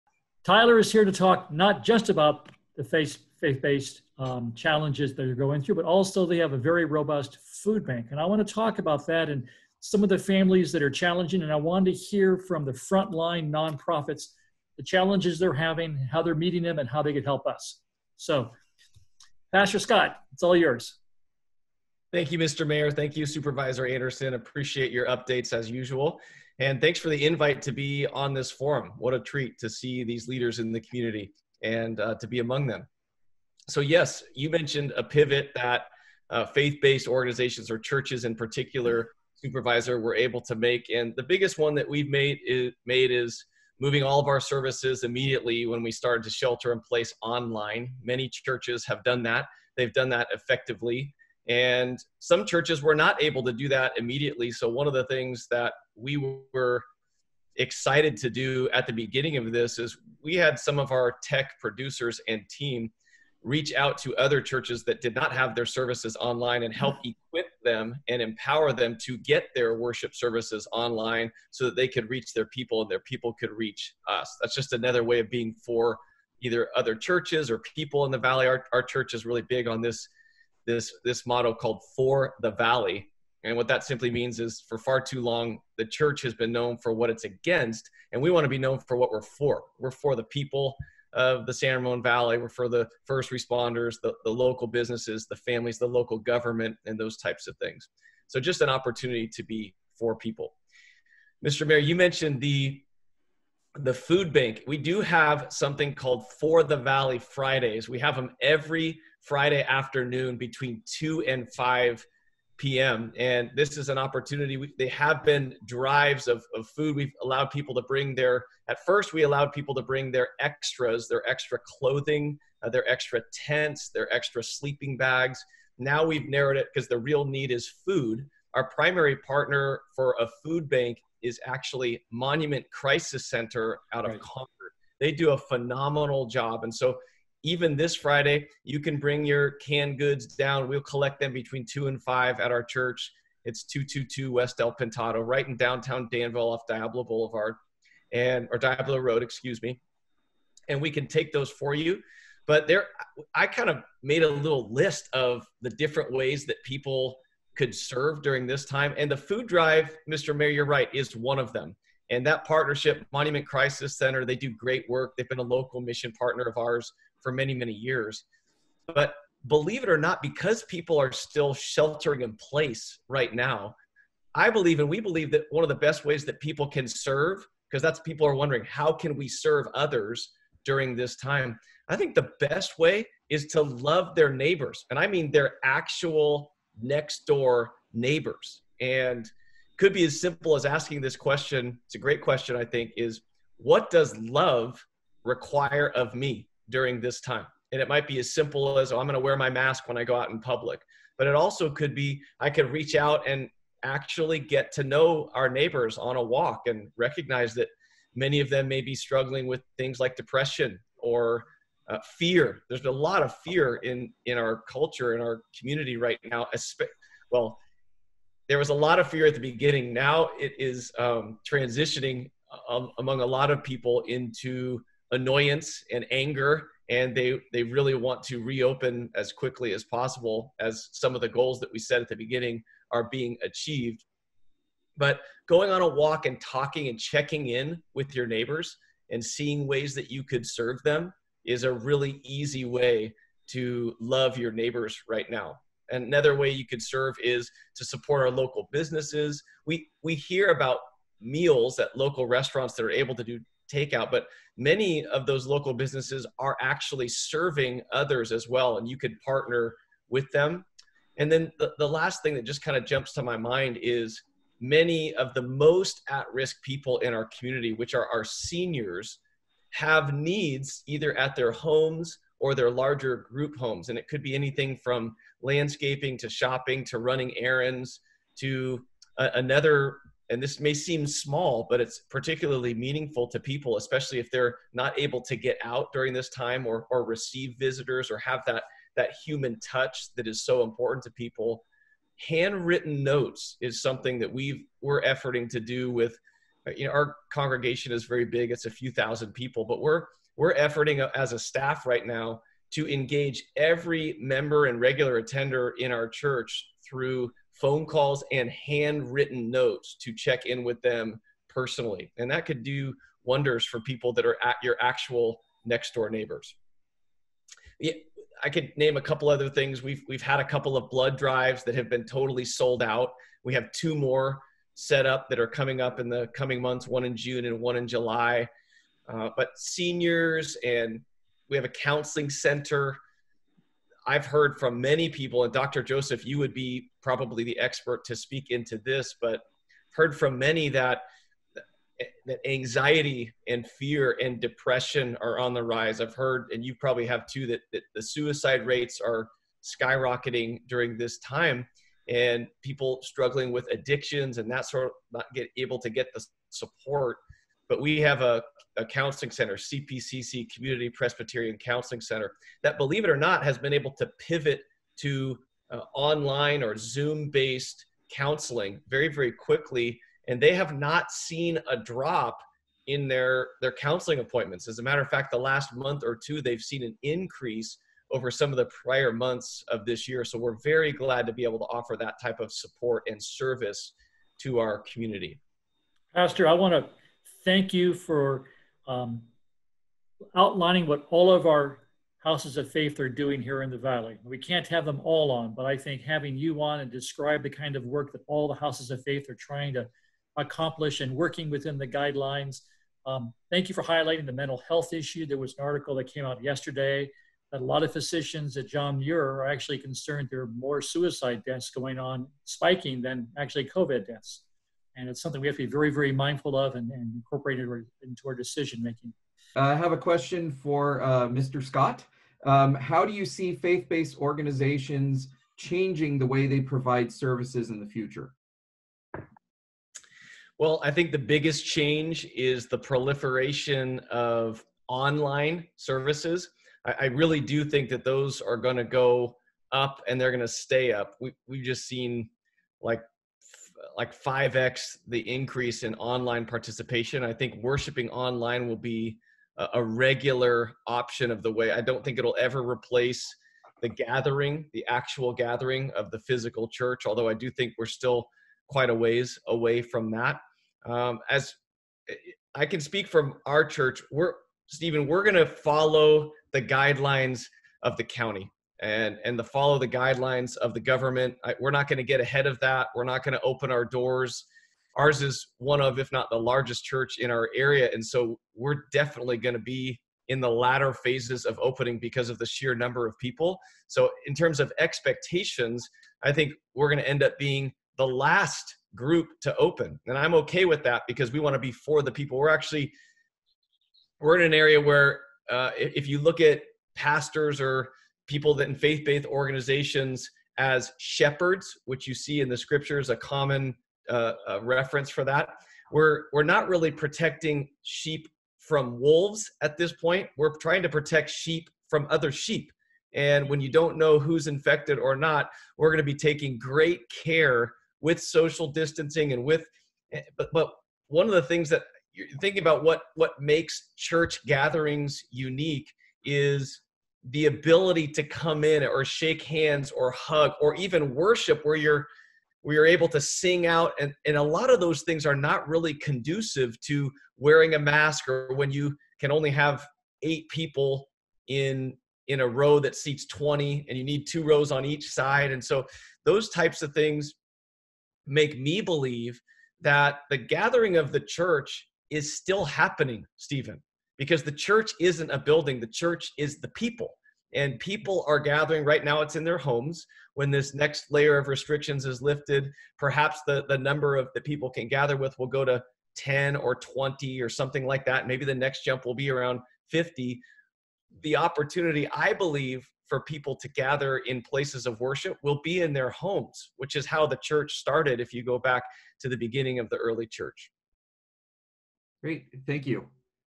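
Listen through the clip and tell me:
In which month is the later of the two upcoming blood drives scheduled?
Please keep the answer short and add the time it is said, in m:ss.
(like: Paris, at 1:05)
July, at 5:27.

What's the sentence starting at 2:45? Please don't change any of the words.
They've been a local mission partner of ours for many, many years.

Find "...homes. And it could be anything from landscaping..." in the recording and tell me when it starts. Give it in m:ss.
4:33.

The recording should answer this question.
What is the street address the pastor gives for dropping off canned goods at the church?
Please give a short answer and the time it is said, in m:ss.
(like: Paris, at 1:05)
222 West El Pintado, at 2:23.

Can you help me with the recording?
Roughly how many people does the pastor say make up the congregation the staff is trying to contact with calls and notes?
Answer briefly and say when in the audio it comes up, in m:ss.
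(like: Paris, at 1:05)
a few thousand, at 4:58.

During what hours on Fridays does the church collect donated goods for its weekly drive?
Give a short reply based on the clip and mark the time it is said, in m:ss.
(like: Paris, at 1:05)
2 to 5 p.m., at 1:50.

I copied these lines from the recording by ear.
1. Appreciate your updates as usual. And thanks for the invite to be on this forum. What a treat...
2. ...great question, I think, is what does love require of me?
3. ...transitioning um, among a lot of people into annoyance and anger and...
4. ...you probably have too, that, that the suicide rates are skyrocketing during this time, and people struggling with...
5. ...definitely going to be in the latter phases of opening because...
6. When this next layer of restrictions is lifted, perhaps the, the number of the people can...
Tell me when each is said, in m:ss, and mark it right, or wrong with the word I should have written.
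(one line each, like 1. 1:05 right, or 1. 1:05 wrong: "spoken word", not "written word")
1. 0:24 right
2. 3:11 right
3. 3:41 right
4. 5:46 right
5. 7:58 right
6. 9:20 right.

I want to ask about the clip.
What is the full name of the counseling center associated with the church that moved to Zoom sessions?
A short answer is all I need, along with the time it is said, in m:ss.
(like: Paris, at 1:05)
Community Presbyterian Counseling Center, at 6:00.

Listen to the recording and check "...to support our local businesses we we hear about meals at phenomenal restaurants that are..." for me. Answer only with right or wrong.
wrong.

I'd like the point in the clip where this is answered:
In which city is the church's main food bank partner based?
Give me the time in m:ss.
2:14.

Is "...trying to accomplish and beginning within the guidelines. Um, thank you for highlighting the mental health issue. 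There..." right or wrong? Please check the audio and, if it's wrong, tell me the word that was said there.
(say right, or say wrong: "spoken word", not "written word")
wrong: "working", not "beginning".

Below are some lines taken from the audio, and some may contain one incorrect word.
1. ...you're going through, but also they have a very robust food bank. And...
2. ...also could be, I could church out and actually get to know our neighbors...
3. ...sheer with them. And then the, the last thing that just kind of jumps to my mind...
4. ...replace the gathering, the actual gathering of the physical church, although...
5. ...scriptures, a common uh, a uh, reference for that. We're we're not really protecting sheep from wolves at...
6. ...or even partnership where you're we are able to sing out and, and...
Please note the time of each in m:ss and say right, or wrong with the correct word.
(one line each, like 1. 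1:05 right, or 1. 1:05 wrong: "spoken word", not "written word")
1. 0:05 right
2. 3:21 wrong: "reach", not "church"
3. 4:19 wrong: "partner", not "sheer"
4. 7:32 right
5. 8:22 right
6. 8:50 wrong: "worship", not "partnership".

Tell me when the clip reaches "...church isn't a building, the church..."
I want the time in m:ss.
9:14.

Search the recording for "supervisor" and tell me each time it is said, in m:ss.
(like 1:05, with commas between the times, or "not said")
0:23, 0:39.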